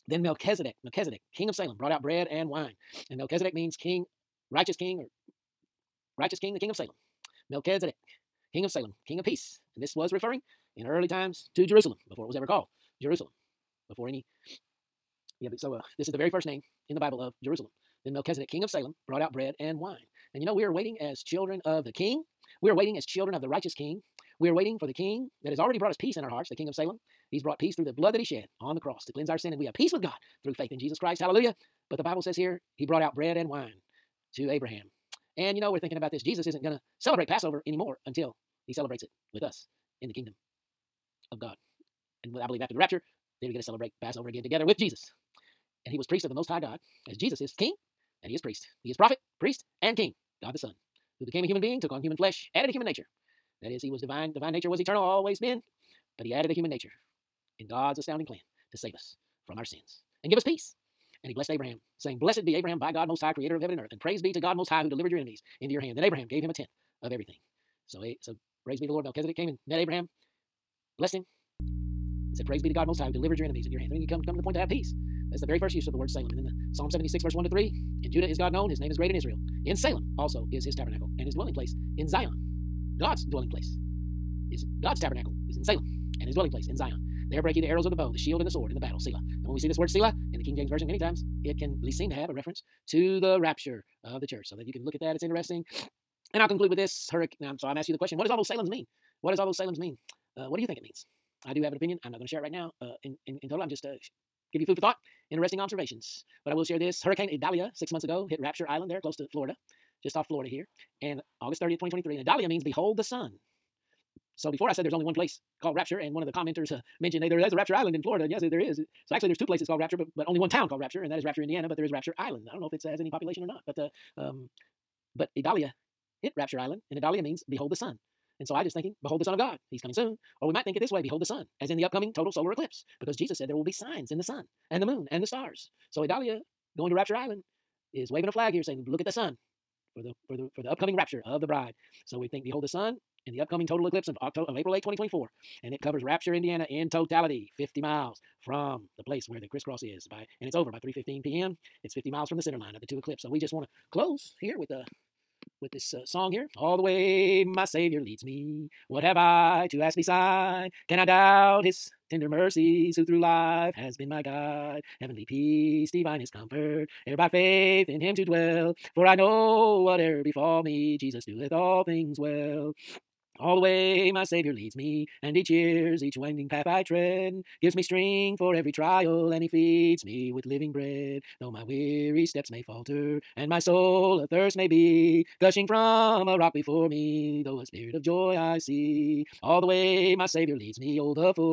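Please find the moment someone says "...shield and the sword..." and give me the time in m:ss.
1:28.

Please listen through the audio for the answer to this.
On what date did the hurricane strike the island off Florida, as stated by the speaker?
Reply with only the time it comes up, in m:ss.
1:51.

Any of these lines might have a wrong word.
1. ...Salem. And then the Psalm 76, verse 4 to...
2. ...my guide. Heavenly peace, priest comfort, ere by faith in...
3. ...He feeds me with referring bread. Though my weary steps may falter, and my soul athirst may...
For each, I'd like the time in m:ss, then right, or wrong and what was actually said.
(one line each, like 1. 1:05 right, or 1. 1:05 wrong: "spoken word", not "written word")
1. 1:16 wrong: "1", not "4"
2. 2:44 wrong: "divinest", not "priest"
3. 2:59 wrong: "living", not "referring".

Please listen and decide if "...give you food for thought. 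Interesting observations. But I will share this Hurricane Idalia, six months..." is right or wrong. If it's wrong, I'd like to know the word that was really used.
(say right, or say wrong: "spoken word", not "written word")
right.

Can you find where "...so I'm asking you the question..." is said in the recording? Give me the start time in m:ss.
1:37.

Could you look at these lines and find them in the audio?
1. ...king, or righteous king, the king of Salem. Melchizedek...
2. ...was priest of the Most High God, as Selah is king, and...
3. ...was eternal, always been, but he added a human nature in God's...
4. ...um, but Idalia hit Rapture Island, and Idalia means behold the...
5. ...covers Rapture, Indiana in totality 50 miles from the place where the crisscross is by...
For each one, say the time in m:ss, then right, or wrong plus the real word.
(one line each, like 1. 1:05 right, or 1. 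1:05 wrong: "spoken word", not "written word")
1. 0:04 right
2. 0:45 wrong: "Jesus", not "Selah"
3. 0:54 right
4. 2:04 right
5. 2:25 right.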